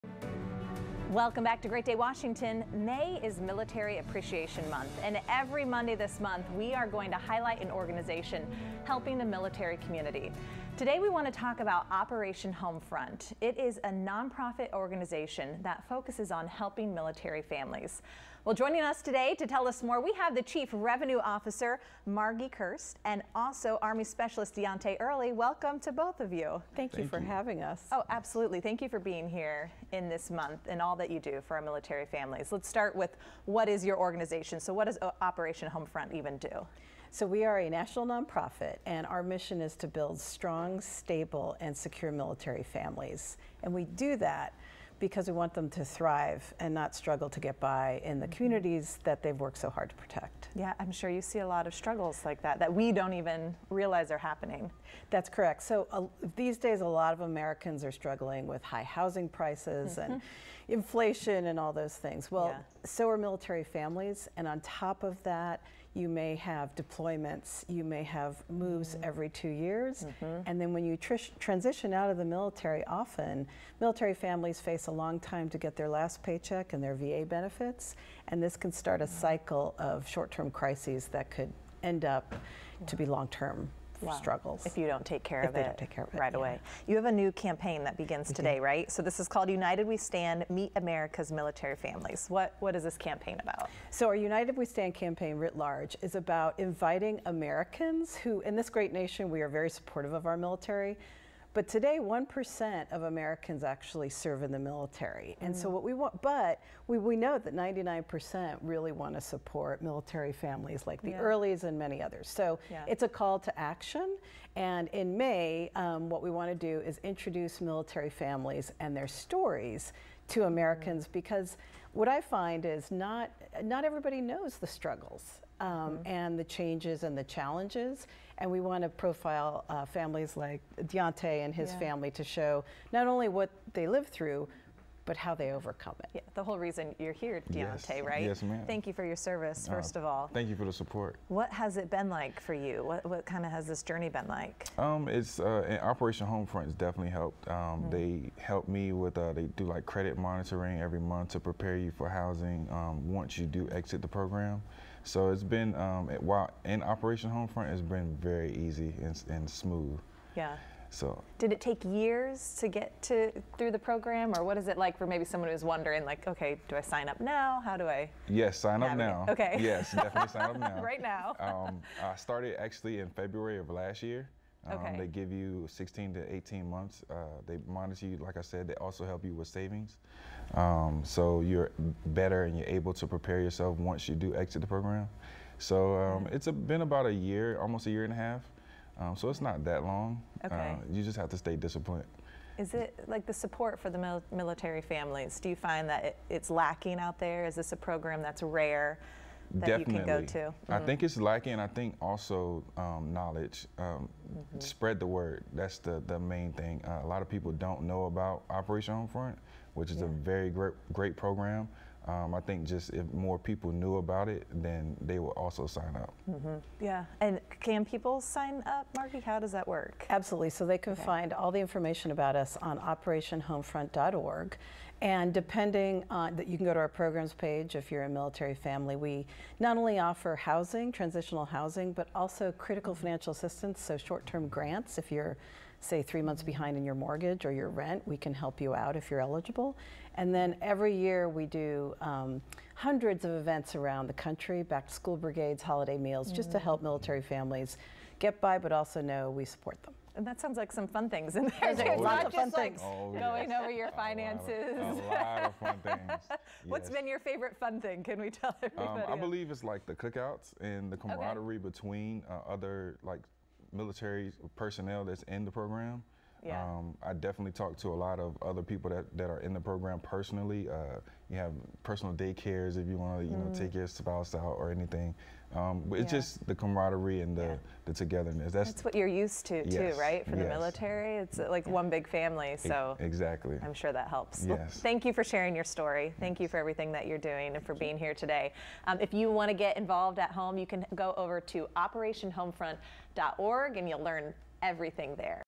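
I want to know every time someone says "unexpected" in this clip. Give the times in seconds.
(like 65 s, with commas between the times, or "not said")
not said.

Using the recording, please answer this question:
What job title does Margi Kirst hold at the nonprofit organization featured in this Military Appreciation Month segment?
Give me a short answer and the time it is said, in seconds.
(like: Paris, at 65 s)
Chief Revenue Officer, at 20 s.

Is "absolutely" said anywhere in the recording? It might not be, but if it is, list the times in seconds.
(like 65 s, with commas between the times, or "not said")
28 s, 220 s.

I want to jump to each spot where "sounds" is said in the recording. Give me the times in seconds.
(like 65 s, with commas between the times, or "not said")
250 s.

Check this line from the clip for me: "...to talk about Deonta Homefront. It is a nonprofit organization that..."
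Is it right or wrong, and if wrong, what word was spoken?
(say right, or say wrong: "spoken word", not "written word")
wrong: "Operation", not "Deonta".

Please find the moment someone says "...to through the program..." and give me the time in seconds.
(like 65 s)
163 s.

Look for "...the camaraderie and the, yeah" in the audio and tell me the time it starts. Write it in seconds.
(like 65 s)
276 s.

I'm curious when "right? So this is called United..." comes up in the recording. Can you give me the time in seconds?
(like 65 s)
88 s.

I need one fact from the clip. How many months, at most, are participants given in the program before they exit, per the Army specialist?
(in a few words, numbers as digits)
18.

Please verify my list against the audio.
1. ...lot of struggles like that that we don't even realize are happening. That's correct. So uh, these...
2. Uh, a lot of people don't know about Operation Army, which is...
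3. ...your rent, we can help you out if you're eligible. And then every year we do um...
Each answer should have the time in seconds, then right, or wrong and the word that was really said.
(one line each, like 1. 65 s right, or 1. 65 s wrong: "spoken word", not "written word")
1. 51 s right
2. 206 s wrong: "Homefront", not "Army"
3. 237 s right.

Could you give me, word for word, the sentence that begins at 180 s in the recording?
Um, so you're better and you're able to prepare yourself once you do exit the program.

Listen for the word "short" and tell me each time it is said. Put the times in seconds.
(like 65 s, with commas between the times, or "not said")
80 s, 233 s.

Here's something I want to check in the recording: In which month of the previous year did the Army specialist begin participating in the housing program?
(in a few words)
February.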